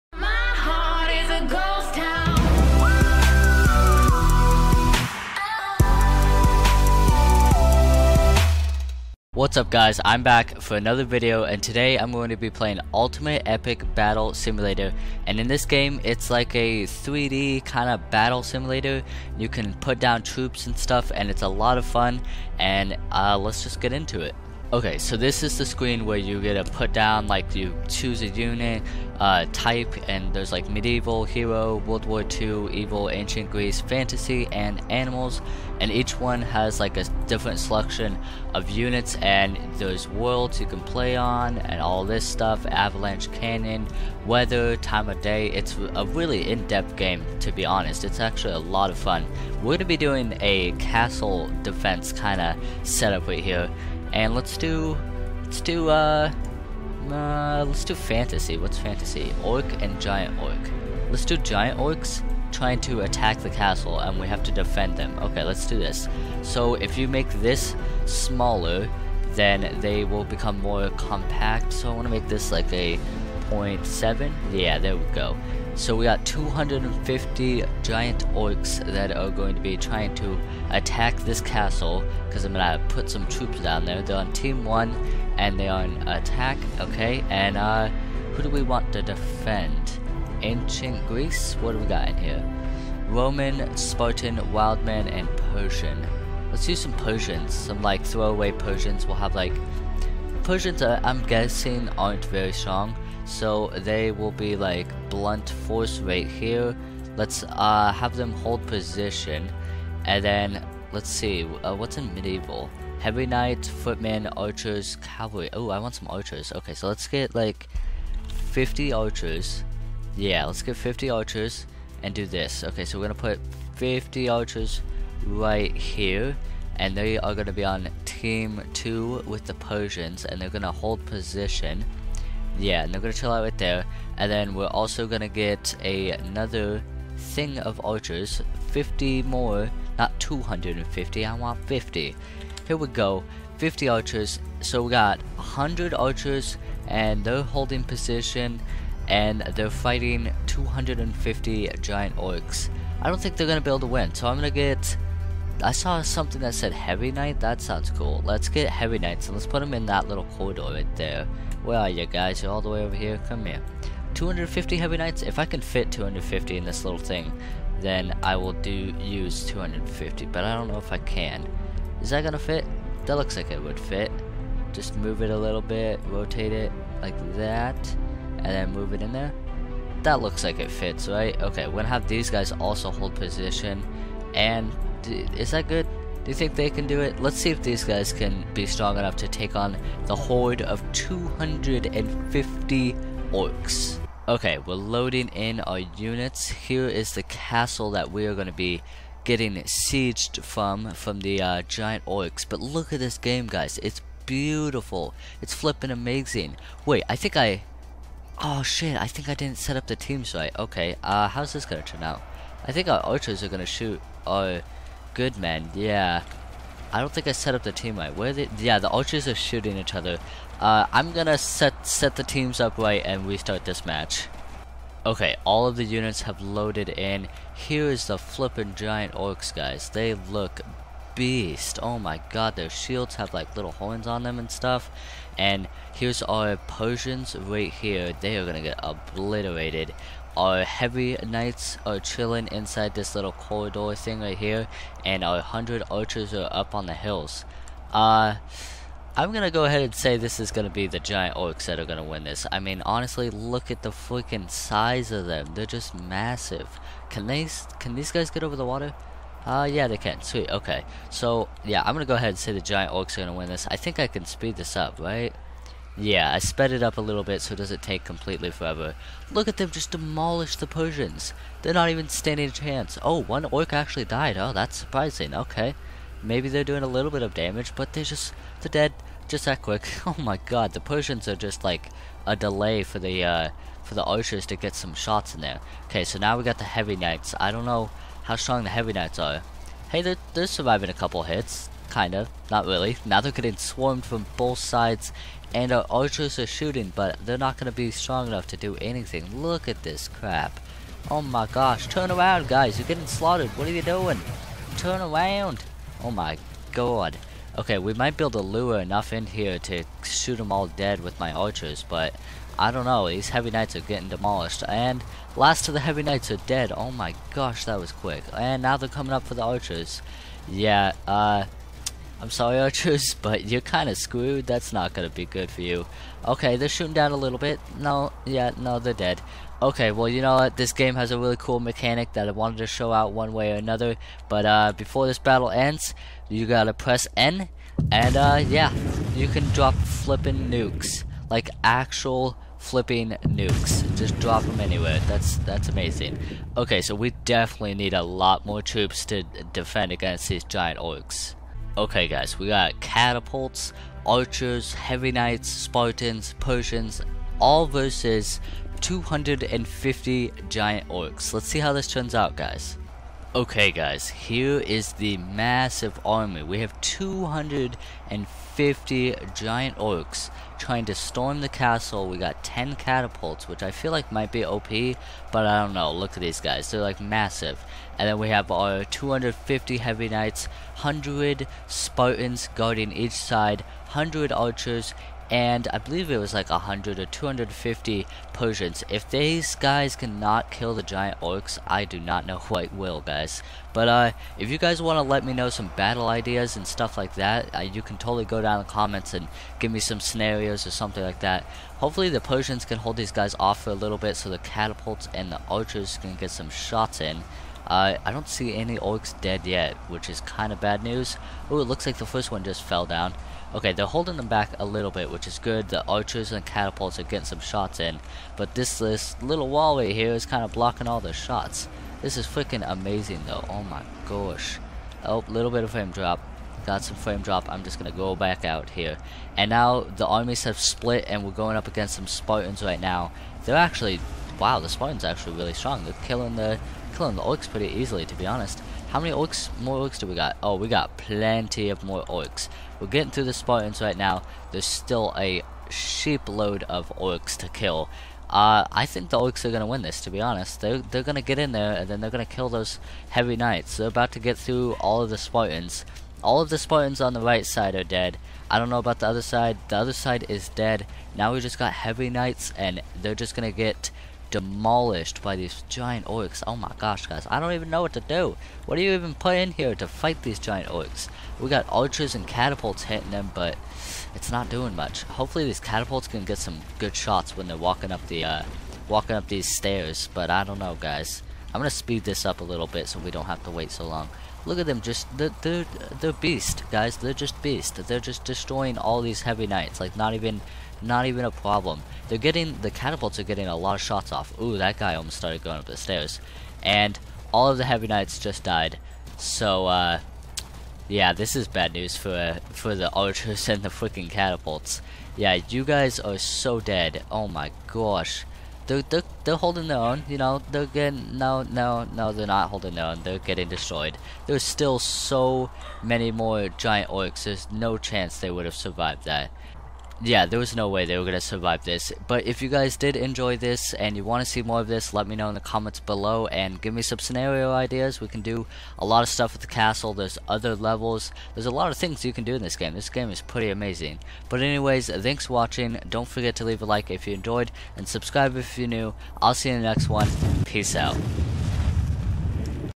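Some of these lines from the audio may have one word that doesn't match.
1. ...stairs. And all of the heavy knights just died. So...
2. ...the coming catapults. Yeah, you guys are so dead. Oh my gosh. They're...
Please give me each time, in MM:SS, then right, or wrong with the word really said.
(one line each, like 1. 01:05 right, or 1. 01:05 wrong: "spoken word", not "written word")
1. 08:15 right
2. 08:23 wrong: "freaking", not "coming".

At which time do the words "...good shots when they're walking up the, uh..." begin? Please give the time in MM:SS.
07:56.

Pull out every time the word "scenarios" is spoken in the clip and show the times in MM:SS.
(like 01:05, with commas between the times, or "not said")
06:40, 08:46.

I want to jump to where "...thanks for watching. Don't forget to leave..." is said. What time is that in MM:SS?
08:54.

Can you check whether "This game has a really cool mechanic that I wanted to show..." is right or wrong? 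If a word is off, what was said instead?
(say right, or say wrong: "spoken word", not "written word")
right.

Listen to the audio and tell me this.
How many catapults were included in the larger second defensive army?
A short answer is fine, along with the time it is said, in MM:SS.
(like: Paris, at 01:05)
10, at 06:12.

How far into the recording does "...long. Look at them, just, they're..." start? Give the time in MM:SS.
08:03.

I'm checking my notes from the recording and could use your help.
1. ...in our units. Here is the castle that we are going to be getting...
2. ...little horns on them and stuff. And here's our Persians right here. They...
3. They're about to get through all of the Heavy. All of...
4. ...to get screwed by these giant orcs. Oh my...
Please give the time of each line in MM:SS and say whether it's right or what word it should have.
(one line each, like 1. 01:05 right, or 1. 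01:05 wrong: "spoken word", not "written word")
1. 03:15 right
2. 03:53 right
3. 07:33 wrong: "Spartans", not "Heavy"
4. 07:43 wrong: "demolished", not "screwed".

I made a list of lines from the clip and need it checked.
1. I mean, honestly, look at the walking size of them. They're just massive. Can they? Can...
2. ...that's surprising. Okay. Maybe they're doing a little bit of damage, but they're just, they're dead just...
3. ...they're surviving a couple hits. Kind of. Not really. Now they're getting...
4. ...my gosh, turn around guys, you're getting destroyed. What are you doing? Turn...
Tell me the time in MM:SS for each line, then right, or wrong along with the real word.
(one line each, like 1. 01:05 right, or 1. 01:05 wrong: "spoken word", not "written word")
1. 04:12 wrong: "freaking", not "walking"
2. 04:34 right
3. 04:50 right
4. 05:01 wrong: "slaughtered", not "destroyed".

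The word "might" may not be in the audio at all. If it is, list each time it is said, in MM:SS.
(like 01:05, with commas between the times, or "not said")
05:07, 06:14.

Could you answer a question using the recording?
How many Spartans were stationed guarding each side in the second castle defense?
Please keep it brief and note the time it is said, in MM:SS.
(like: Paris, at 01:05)
100, at 06:20.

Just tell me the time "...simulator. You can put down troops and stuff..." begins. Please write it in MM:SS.
00:18.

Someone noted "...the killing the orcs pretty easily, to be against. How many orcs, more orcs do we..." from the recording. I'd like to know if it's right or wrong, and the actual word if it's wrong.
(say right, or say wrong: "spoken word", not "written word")
wrong: "honest", not "against".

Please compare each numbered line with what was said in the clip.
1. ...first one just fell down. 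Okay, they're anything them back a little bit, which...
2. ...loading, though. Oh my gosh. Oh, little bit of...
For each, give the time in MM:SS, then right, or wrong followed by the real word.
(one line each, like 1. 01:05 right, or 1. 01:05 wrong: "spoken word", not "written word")
1. 06:52 wrong: "holding", not "anything"
2. 07:02 wrong: "amazing", not "loading".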